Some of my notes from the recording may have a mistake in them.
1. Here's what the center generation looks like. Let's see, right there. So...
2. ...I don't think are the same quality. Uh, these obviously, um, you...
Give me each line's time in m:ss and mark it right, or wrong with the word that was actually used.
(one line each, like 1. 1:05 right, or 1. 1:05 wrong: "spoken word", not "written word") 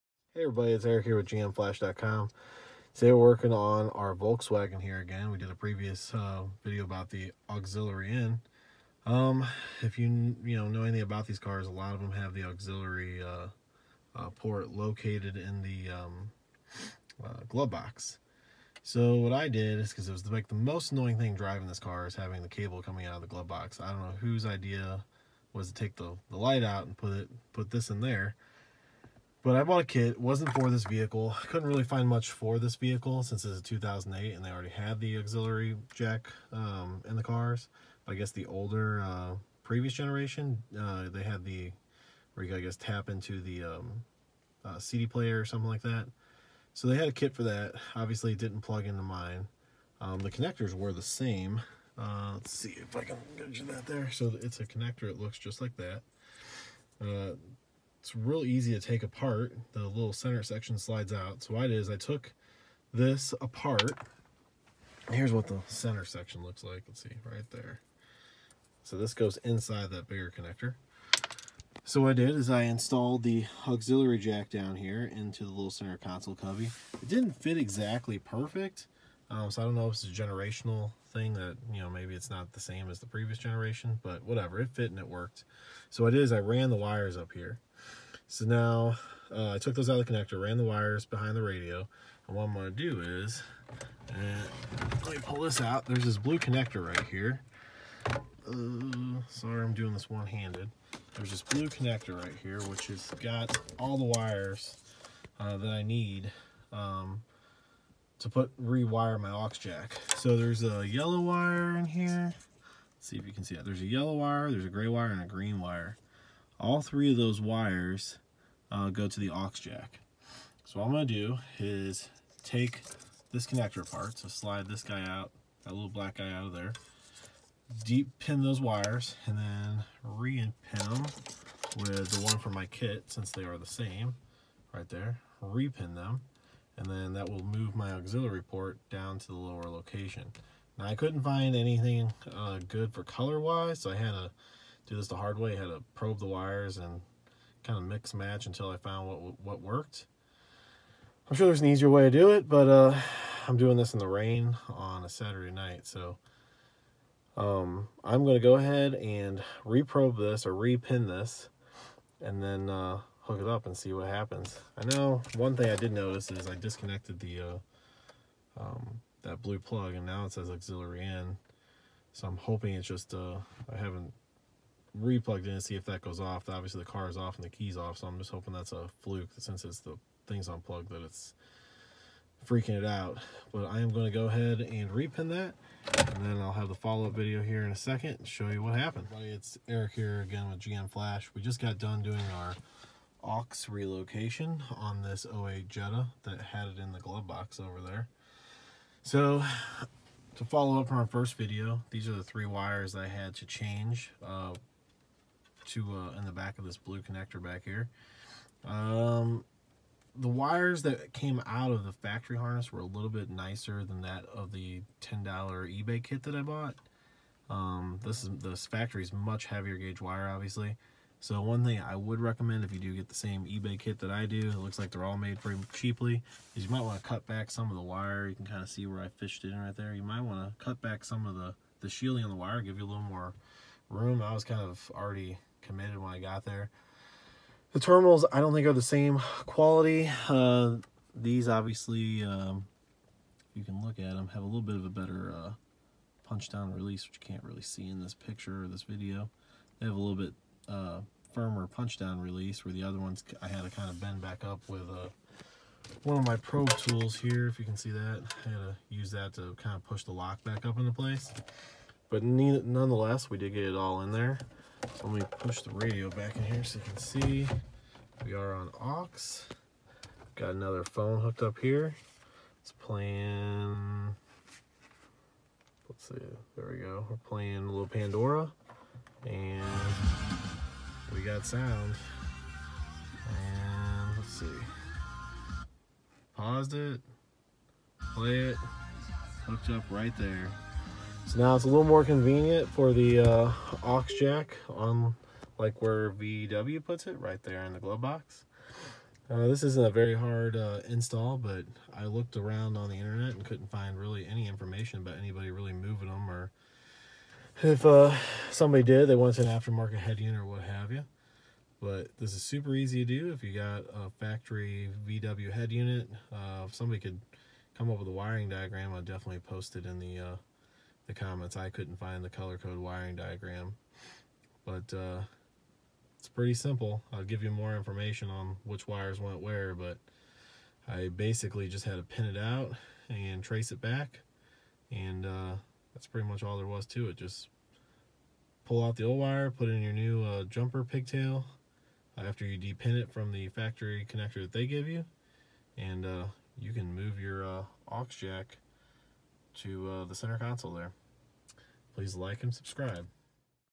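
1. 1:05 wrong: "section", not "generation"
2. 3:58 right.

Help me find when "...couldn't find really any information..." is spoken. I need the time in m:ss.
5:03.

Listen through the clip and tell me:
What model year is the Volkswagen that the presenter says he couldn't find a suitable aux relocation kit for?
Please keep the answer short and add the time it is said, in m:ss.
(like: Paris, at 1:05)
2008, at 0:33.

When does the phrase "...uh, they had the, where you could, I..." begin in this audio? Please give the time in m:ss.
0:40.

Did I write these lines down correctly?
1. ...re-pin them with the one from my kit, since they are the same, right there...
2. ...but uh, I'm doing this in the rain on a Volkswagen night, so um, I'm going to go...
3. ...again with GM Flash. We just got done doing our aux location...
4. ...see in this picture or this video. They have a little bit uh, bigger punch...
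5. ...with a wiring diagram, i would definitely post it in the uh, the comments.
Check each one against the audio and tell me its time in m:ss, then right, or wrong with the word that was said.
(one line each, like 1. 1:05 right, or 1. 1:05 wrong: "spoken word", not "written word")
1. 2:10 right
2. 2:32 wrong: "Saturday", not "Volkswagen"
3. 3:10 wrong: "relocation", not "location"
4. 4:07 wrong: "firmer", not "bigger"
5. 5:17 right.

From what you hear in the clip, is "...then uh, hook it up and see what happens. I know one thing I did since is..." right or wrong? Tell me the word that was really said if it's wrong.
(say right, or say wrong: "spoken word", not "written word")
wrong: "notice", not "since".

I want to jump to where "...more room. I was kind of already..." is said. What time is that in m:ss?
3:53.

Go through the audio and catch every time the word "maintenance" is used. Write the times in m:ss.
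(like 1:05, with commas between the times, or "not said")
not said.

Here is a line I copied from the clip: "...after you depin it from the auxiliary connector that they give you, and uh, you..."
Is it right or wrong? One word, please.
wrong.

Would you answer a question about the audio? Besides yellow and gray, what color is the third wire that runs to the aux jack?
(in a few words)
Green.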